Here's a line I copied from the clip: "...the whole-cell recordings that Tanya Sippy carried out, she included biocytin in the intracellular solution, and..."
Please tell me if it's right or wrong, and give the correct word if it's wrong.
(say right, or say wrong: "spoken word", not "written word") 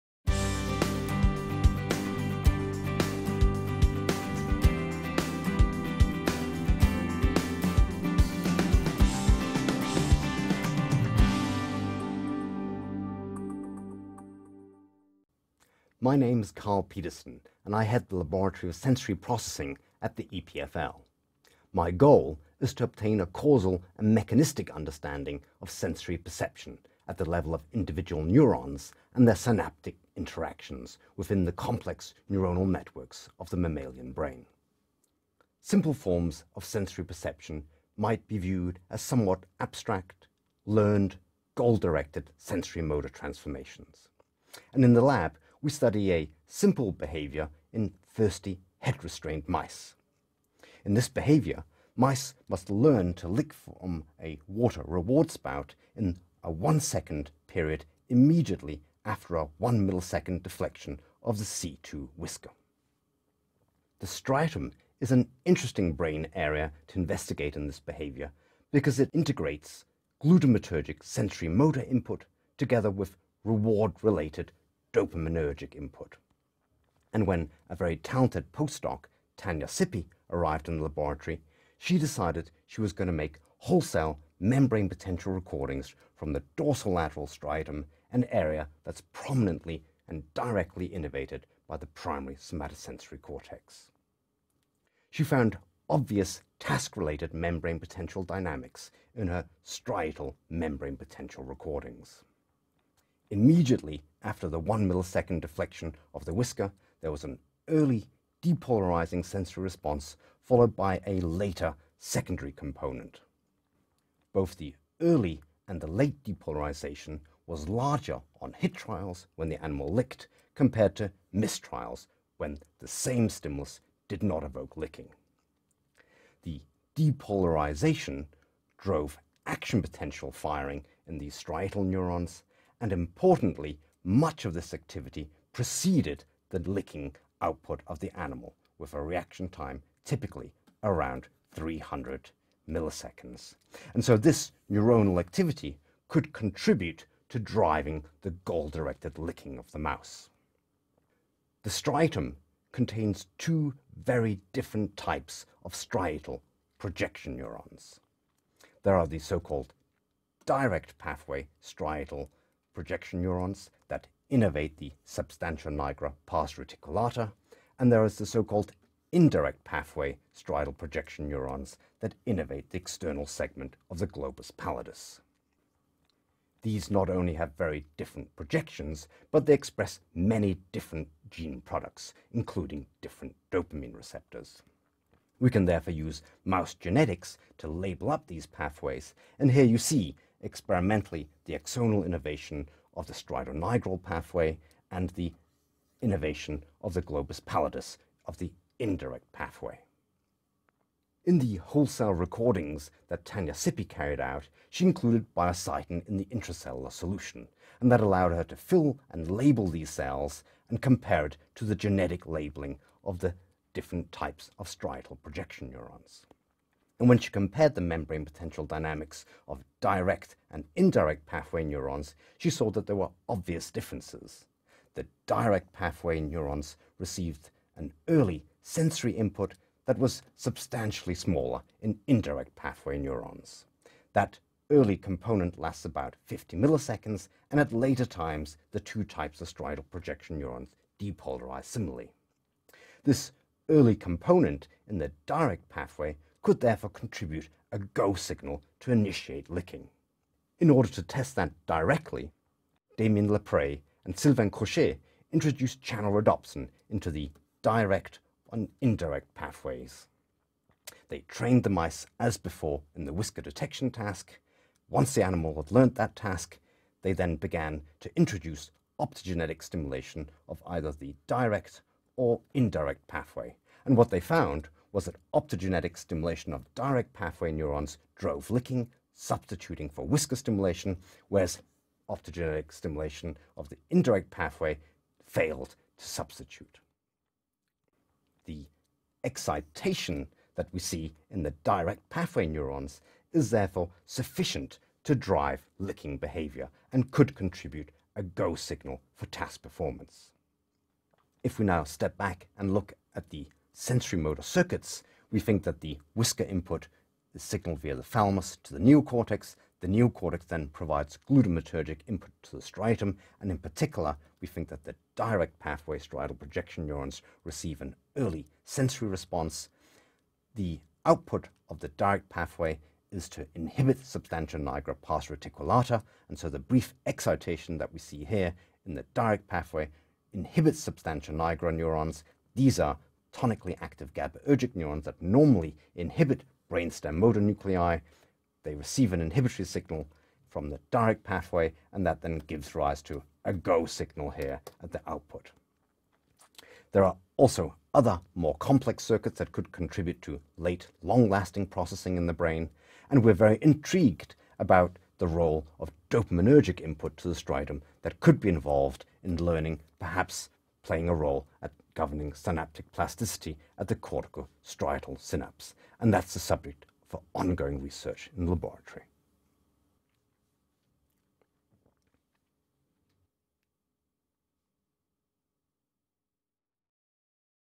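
right.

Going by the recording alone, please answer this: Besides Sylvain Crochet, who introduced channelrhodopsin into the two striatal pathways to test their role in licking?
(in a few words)
Damien Lapray.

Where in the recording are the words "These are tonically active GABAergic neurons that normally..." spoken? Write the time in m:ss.
5:32.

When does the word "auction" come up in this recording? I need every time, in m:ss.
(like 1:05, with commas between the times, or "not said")
not said.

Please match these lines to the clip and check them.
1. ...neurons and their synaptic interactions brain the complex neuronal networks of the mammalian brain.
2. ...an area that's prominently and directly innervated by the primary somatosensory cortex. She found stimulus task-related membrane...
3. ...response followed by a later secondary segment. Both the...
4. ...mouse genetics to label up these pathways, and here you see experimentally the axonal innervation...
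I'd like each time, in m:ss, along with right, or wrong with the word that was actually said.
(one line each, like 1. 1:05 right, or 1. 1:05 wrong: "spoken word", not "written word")
1. 0:28 wrong: "within", not "brain"
2. 1:28 wrong: "obvious", not "stimulus"
3. 1:49 wrong: "component", not "segment"
4. 3:06 right.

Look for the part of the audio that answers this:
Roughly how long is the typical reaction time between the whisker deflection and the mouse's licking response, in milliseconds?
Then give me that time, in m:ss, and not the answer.
2:21.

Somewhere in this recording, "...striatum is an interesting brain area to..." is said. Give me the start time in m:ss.
1:04.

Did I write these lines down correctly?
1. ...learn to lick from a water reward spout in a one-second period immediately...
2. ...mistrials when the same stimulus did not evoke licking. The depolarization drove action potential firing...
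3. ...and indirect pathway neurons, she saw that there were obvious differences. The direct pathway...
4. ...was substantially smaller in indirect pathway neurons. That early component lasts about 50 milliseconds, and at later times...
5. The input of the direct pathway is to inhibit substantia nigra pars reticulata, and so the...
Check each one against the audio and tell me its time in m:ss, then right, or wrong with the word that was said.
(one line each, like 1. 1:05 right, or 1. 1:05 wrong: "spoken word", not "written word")
1. 0:52 right
2. 2:01 right
3. 3:40 right
4. 3:49 right
5. 5:20 wrong: "output", not "input".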